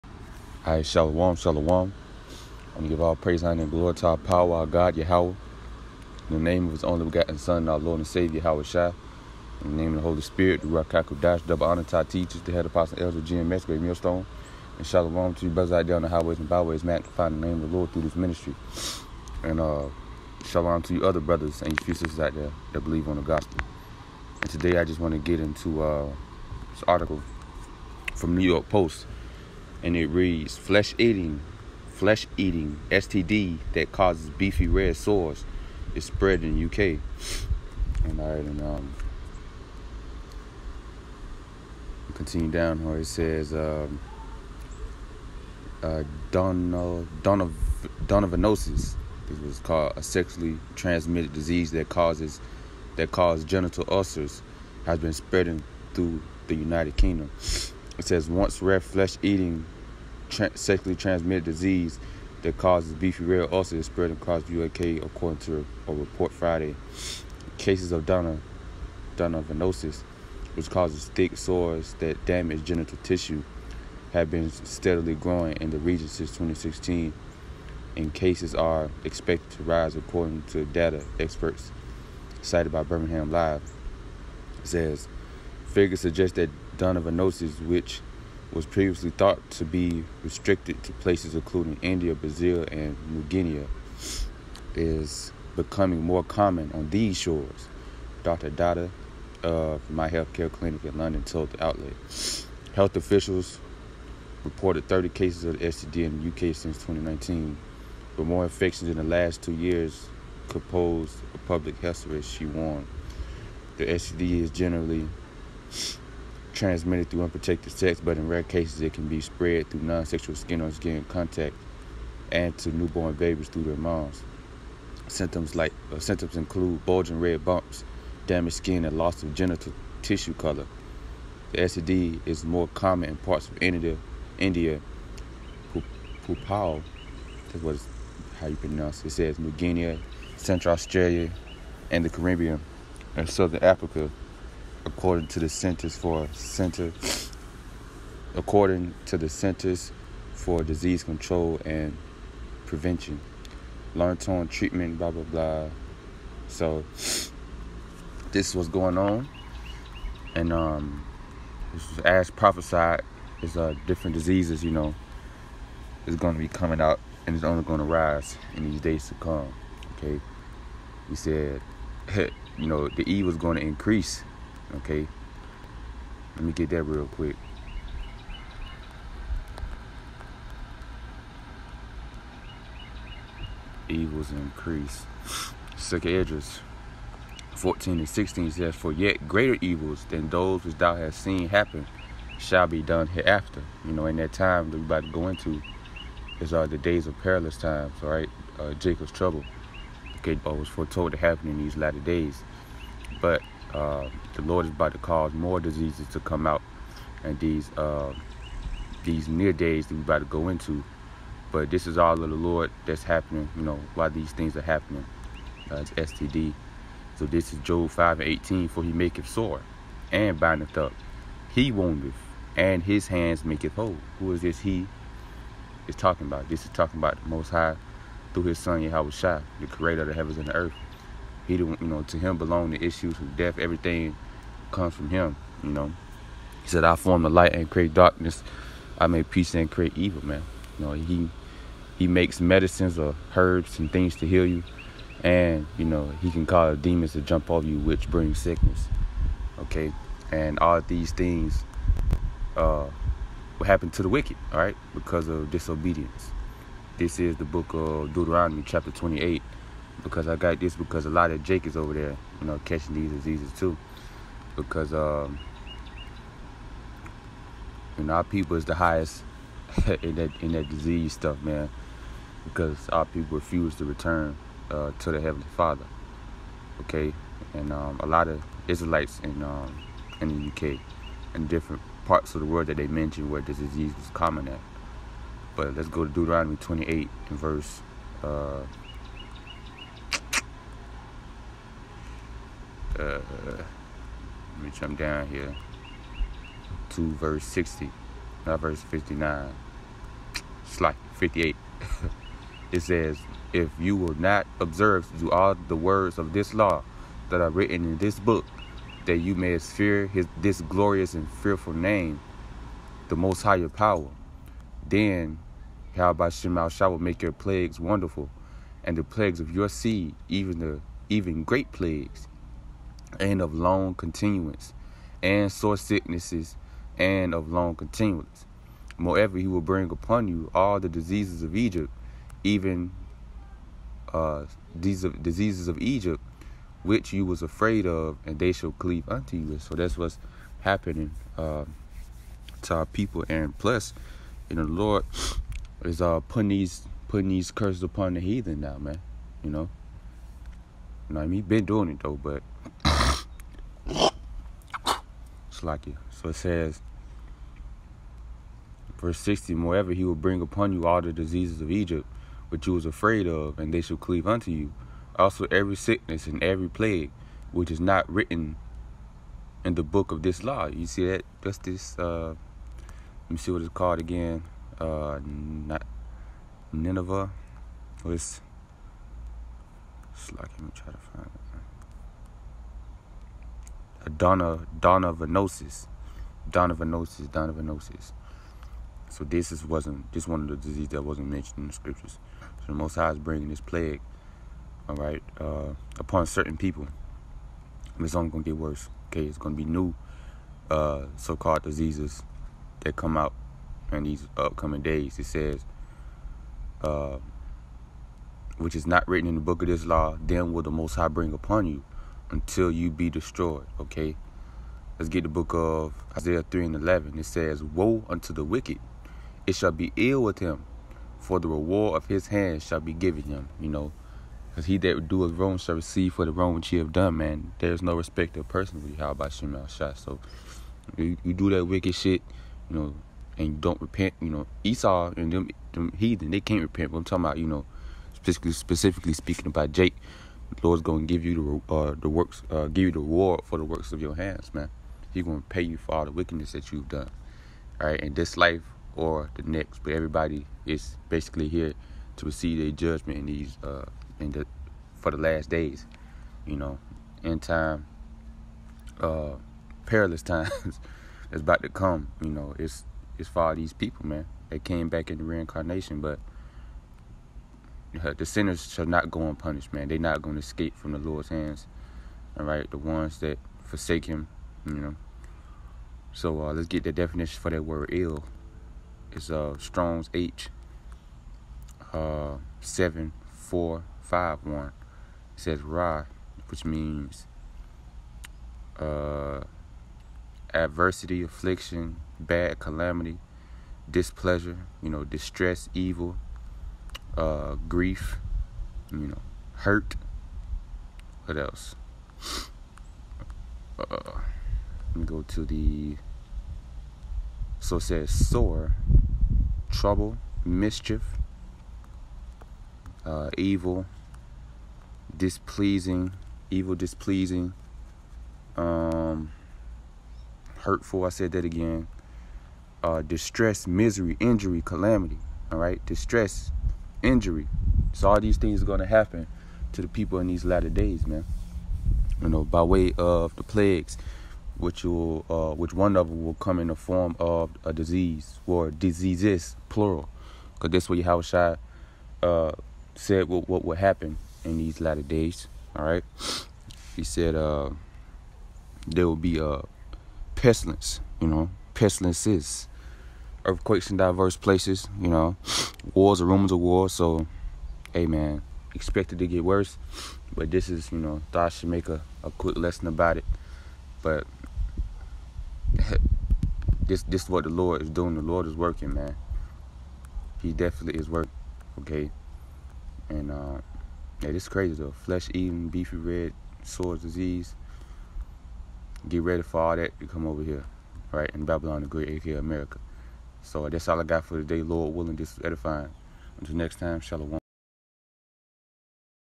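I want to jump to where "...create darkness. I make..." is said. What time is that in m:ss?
3:57.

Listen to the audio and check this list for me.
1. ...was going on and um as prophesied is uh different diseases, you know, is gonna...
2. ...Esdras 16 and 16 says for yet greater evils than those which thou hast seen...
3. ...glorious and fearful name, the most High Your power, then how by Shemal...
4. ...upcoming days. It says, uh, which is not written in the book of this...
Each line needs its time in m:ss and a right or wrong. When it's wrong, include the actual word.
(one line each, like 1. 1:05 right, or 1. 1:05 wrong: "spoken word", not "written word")
1. 2:38 right
2. 3:06 wrong: "14", not "16"
3. 5:10 right
4. 6:44 right.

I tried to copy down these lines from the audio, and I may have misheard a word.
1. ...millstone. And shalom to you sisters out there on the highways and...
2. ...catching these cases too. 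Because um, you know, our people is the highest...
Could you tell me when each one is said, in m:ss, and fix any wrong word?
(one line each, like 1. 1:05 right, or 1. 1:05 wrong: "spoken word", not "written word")
1. 0:13 wrong: "brothers", not "sisters"
2. 4:22 wrong: "diseases", not "cases".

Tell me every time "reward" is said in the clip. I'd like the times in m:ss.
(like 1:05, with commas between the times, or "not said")
7:01, 7:22.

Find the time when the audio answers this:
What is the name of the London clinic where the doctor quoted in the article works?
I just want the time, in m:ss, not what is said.
1:39.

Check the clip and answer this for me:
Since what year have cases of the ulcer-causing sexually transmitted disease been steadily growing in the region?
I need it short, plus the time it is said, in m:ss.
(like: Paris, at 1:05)
2016, at 1:16.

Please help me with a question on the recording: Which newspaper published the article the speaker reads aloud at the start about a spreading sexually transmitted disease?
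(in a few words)
New York Post.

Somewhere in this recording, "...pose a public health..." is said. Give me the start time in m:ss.
1:50.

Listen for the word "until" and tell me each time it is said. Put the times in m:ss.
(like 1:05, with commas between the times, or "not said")
6:52, 9:46.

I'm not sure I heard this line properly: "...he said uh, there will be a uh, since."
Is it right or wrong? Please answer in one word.
wrong.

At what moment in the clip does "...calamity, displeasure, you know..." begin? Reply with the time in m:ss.
8:12.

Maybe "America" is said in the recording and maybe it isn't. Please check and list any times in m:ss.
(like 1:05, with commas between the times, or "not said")
9:42.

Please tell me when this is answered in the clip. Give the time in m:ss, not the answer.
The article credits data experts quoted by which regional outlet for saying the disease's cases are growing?
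1:22.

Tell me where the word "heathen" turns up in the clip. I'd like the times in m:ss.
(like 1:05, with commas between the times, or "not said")
5:48, 7:15.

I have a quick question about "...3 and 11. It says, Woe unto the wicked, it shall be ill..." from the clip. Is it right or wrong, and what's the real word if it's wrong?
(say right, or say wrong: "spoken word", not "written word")
right.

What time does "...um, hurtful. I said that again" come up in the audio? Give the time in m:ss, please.
8:38.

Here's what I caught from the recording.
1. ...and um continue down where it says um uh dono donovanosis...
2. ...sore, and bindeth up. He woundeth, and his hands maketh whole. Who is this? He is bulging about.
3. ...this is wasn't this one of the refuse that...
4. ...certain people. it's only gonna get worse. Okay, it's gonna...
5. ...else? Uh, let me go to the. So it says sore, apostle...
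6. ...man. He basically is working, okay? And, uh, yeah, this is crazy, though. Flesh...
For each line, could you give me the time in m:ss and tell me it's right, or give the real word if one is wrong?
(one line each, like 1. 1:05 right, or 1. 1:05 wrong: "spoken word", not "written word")
1. 0:38 right
2. 3:39 wrong: "talking", not "bulging"
3. 6:29 wrong: "disease", not "refuse"
4. 6:36 right
5. 8:21 wrong: "trouble", not "apostle"
6. 9:28 wrong: "definitely", not "basically".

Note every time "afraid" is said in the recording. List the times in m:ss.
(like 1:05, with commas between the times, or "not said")
5:37, 6:02.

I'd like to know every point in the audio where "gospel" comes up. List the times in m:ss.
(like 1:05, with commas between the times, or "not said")
0:23.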